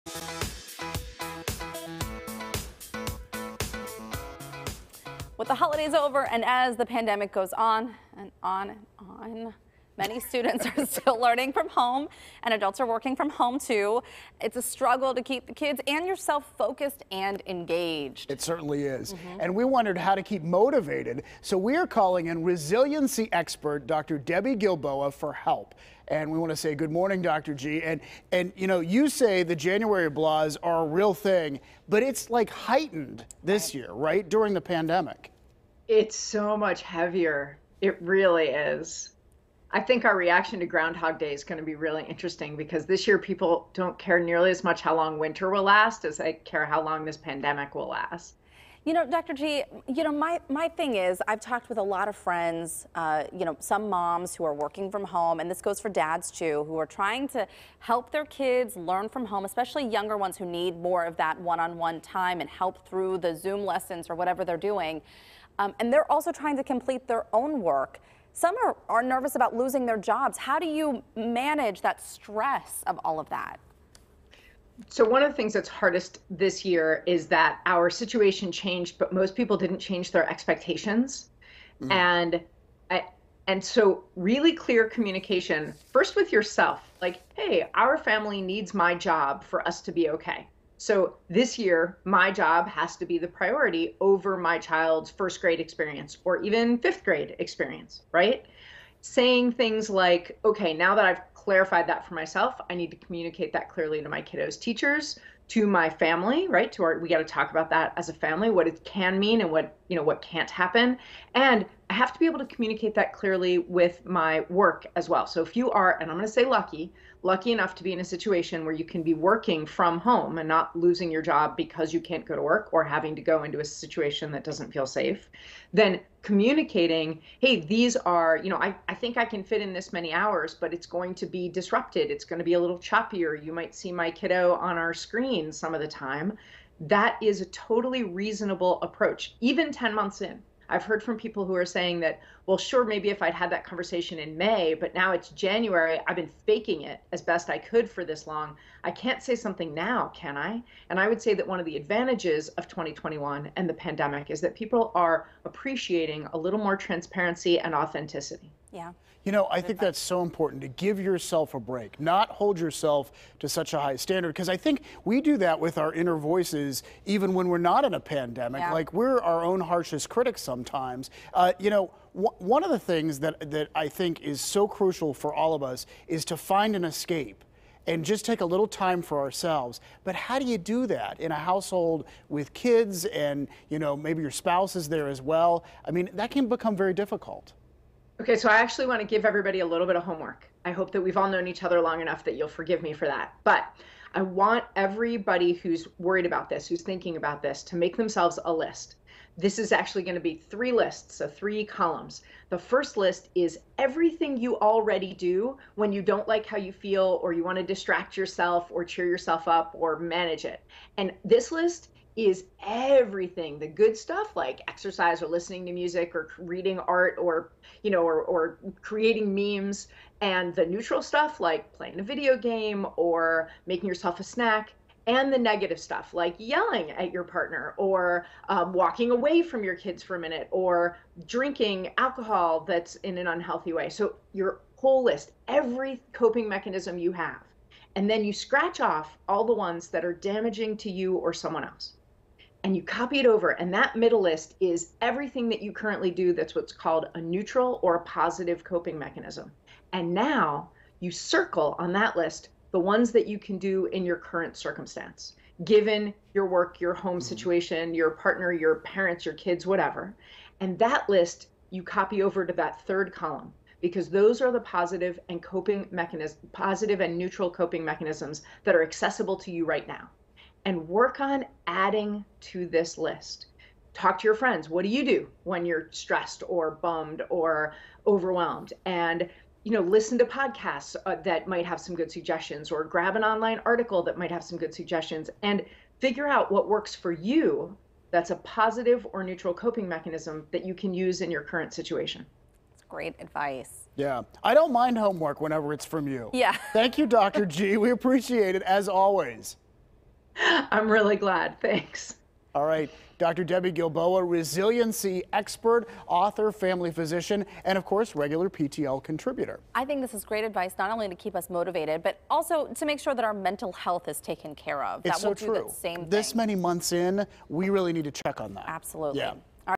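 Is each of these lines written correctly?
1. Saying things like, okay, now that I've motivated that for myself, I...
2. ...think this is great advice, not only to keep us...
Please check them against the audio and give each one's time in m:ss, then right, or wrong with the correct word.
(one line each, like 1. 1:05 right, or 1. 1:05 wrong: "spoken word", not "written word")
1. 1:39 wrong: "clarified", not "motivated"
2. 5:09 right.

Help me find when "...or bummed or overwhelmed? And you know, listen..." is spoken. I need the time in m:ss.
4:36.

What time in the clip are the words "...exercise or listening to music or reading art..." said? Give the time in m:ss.
3:34.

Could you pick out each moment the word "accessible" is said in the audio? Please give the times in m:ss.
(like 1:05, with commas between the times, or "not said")
4:28.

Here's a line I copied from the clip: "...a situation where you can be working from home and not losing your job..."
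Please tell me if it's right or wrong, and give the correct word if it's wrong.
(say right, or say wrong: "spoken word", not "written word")
right.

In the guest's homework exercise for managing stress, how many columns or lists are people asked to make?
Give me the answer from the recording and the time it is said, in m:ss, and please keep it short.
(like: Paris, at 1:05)
3, at 3:20.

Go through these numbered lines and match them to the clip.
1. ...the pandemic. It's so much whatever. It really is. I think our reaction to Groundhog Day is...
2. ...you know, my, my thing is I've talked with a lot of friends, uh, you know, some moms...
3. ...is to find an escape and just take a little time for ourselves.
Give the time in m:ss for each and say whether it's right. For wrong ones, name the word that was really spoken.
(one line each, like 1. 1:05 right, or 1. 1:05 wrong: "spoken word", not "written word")
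1. 0:34 wrong: "heavier", not "whatever"
2. 0:49 right
3. 2:56 right.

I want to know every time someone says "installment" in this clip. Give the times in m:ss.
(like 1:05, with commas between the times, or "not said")
not said.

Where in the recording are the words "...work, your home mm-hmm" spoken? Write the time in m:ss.
4:16.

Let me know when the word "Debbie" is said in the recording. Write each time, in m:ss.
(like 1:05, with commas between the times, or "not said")
0:24, 5:03.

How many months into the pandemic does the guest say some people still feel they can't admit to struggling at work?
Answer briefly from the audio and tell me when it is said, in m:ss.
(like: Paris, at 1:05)
10, at 2:19.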